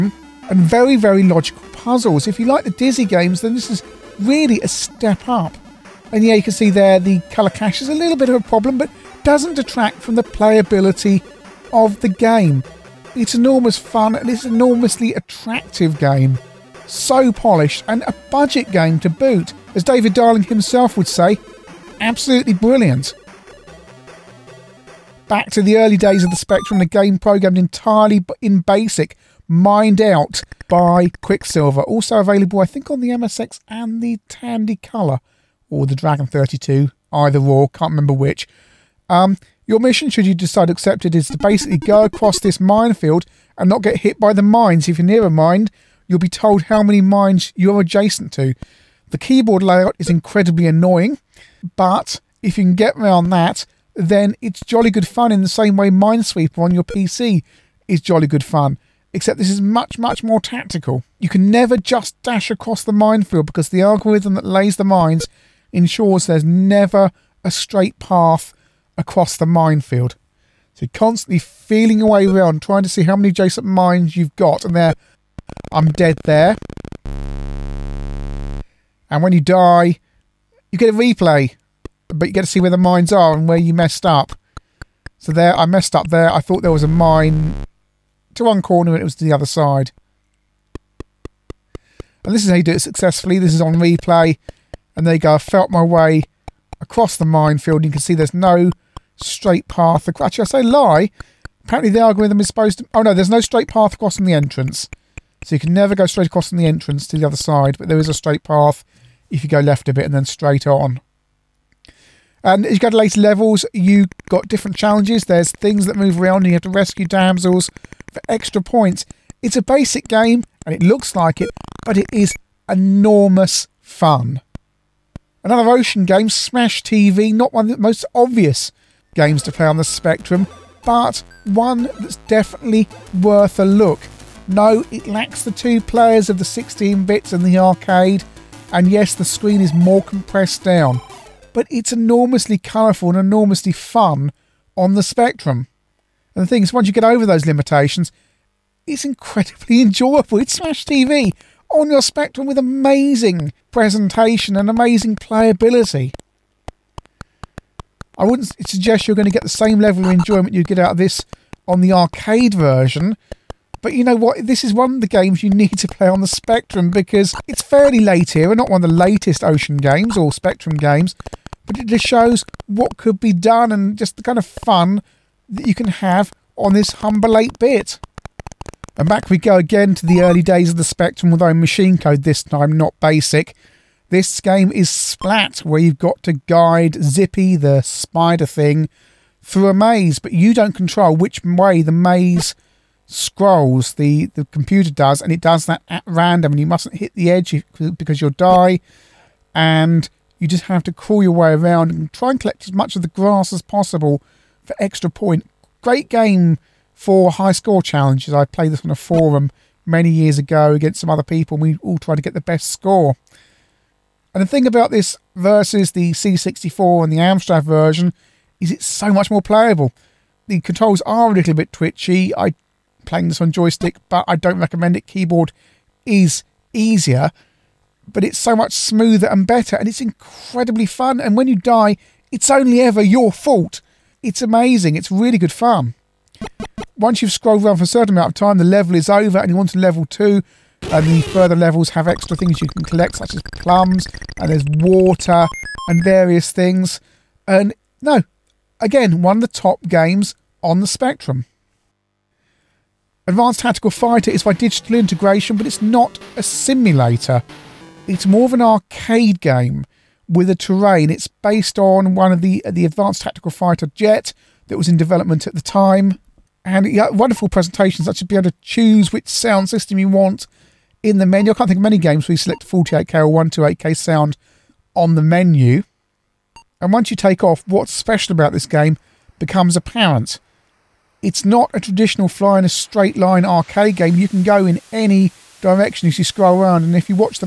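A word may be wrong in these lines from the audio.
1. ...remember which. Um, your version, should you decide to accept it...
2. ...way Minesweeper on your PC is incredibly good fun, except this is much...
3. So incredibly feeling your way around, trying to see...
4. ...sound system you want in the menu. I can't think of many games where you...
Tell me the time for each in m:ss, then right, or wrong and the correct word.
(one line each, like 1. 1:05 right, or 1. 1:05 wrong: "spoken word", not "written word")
1. 0:37 wrong: "mission", not "version"
2. 0:55 wrong: "jolly", not "incredibly"
3. 1:10 wrong: "constantly", not "incredibly"
4. 4:29 right.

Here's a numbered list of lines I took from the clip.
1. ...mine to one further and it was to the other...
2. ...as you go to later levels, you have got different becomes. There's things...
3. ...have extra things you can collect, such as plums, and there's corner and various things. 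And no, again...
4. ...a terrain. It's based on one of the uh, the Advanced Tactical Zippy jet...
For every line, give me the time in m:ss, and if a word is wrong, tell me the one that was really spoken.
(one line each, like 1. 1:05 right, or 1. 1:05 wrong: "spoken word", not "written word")
1. 1:26 wrong: "corner", not "further"
2. 1:52 wrong: "challenges", not "becomes"
3. 4:01 wrong: "water", not "corner"
4. 4:20 wrong: "Fighter", not "Zippy".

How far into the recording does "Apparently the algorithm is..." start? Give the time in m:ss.
1:41.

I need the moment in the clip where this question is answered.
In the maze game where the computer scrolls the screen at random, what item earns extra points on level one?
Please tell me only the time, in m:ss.
3:23.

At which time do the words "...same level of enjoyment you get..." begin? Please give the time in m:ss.
2:39.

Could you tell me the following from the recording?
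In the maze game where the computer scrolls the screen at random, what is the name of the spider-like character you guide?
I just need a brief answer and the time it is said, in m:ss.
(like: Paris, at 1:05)
Zippy, at 3:07.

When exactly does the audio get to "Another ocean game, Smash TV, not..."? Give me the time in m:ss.
2:05.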